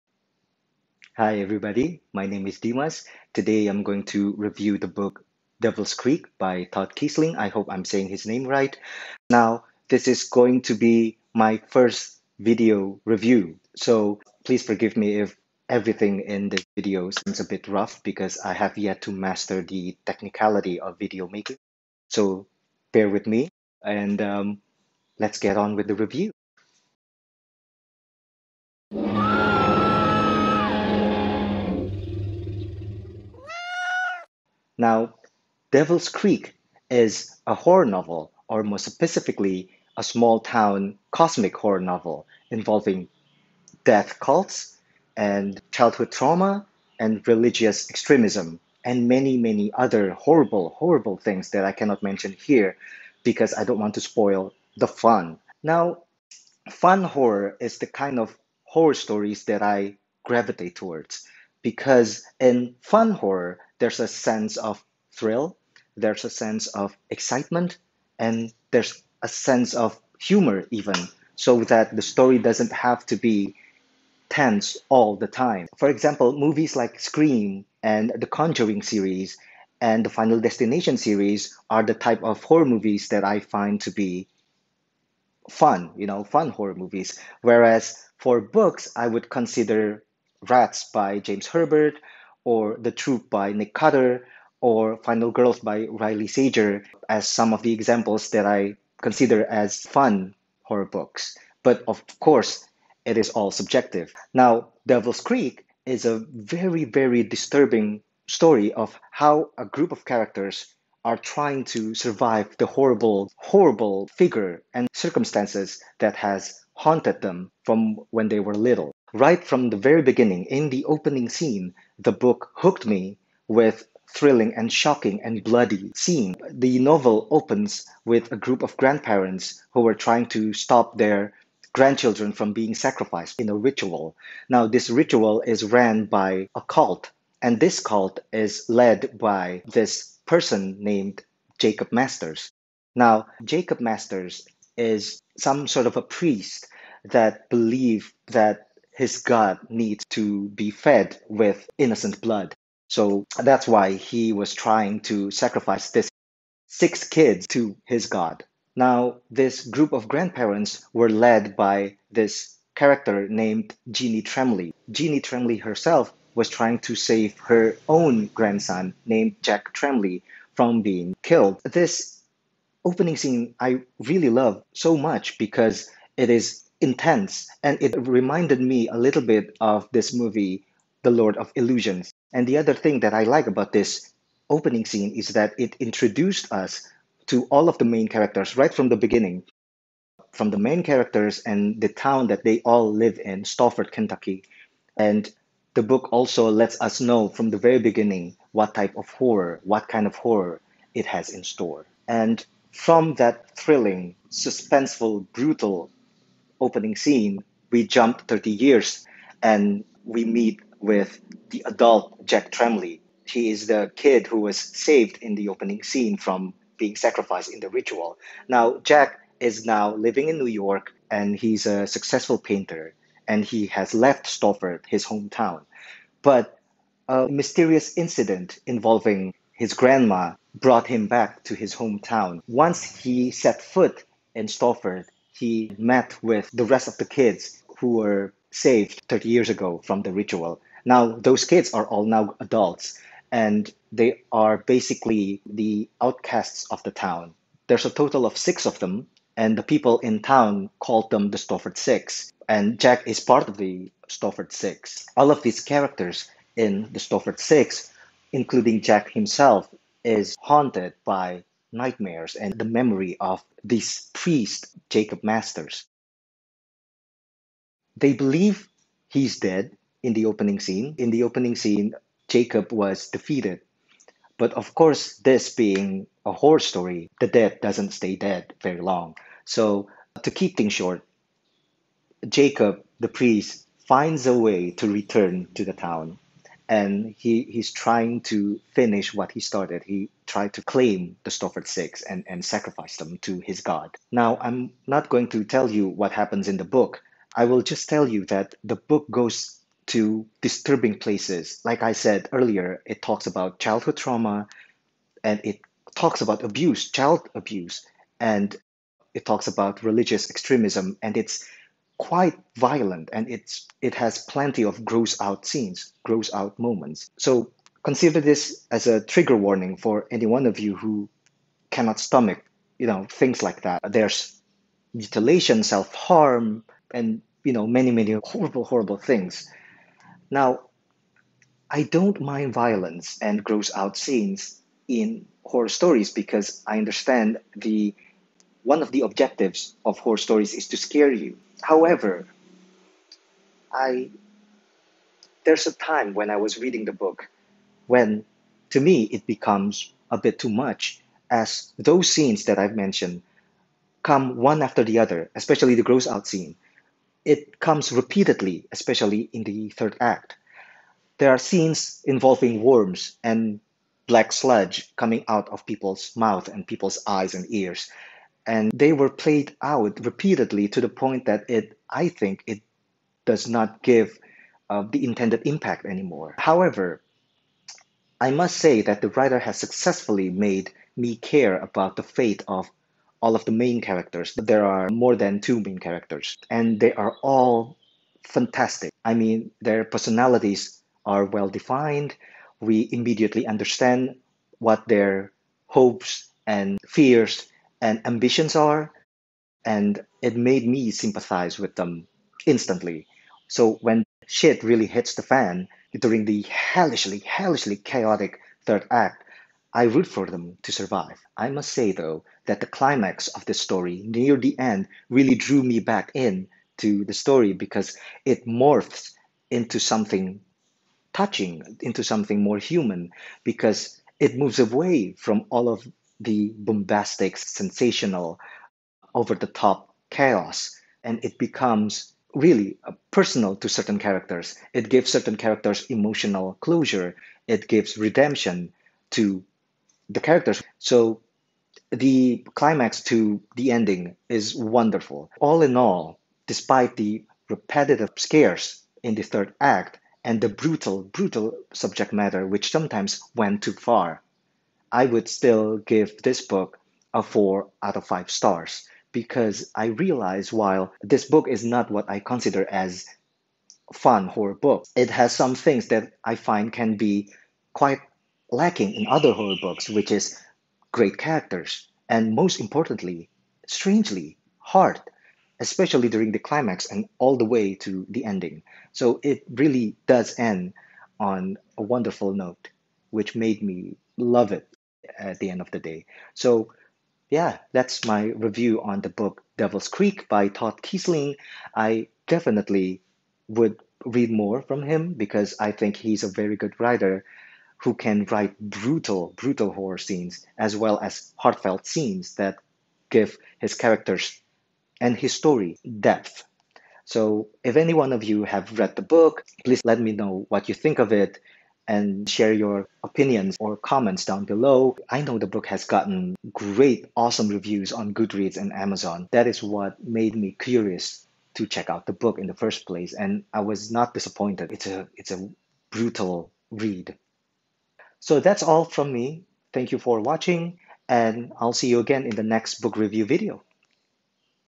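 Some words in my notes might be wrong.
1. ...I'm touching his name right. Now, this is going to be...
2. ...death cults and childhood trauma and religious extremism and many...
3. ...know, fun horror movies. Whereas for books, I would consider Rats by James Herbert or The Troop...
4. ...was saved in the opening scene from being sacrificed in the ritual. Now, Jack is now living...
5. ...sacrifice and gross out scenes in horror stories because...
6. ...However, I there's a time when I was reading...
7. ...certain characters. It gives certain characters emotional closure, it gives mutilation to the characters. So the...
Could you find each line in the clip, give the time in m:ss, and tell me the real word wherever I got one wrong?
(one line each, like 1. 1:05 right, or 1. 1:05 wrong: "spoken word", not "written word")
1. 0:07 wrong: "saying", not "touching"
2. 0:43 right
3. 1:26 right
4. 3:34 right
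5. 5:32 wrong: "violence", not "sacrifice"
6. 5:41 right
7. 7:13 wrong: "redemption", not "mutilation".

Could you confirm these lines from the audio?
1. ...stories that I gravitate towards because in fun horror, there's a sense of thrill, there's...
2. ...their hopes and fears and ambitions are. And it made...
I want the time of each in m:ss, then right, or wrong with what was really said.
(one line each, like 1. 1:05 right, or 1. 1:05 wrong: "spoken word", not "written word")
1. 0:58 right
2. 6:34 right.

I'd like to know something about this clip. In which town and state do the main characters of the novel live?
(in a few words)
Stafford, Kentucky.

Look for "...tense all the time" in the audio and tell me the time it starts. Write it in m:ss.
1:14.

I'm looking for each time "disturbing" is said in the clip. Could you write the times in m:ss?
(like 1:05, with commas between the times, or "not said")
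1:47, 5:00.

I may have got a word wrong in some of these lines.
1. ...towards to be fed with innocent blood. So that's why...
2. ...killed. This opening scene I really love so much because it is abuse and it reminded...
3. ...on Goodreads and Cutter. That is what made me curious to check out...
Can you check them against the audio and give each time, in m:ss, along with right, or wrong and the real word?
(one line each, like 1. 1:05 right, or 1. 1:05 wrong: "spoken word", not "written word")
1. 2:29 wrong: "needs", not "towards"
2. 2:51 wrong: "intense", not "abuse"
3. 8:37 wrong: "Amazon", not "Cutter".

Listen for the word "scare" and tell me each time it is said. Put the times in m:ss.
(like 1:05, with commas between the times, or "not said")
5:40, 7:28.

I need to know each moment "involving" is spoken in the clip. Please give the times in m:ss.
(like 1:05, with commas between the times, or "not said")
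0:42, 3:48, 6:02.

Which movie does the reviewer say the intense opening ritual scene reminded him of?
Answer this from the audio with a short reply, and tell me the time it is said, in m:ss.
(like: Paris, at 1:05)
Lord of Illusions, at 3:01.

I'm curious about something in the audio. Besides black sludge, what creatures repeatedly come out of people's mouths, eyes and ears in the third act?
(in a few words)
worms.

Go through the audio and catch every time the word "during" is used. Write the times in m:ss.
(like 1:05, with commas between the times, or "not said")
6:45, 7:56.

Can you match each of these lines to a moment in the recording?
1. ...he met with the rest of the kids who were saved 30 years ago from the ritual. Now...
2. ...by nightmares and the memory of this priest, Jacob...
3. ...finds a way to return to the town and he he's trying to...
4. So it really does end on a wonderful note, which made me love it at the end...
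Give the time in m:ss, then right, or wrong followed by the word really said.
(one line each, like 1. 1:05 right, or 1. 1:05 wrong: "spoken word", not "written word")
1. 3:55 right
2. 4:21 right
3. 4:43 right
4. 7:58 right.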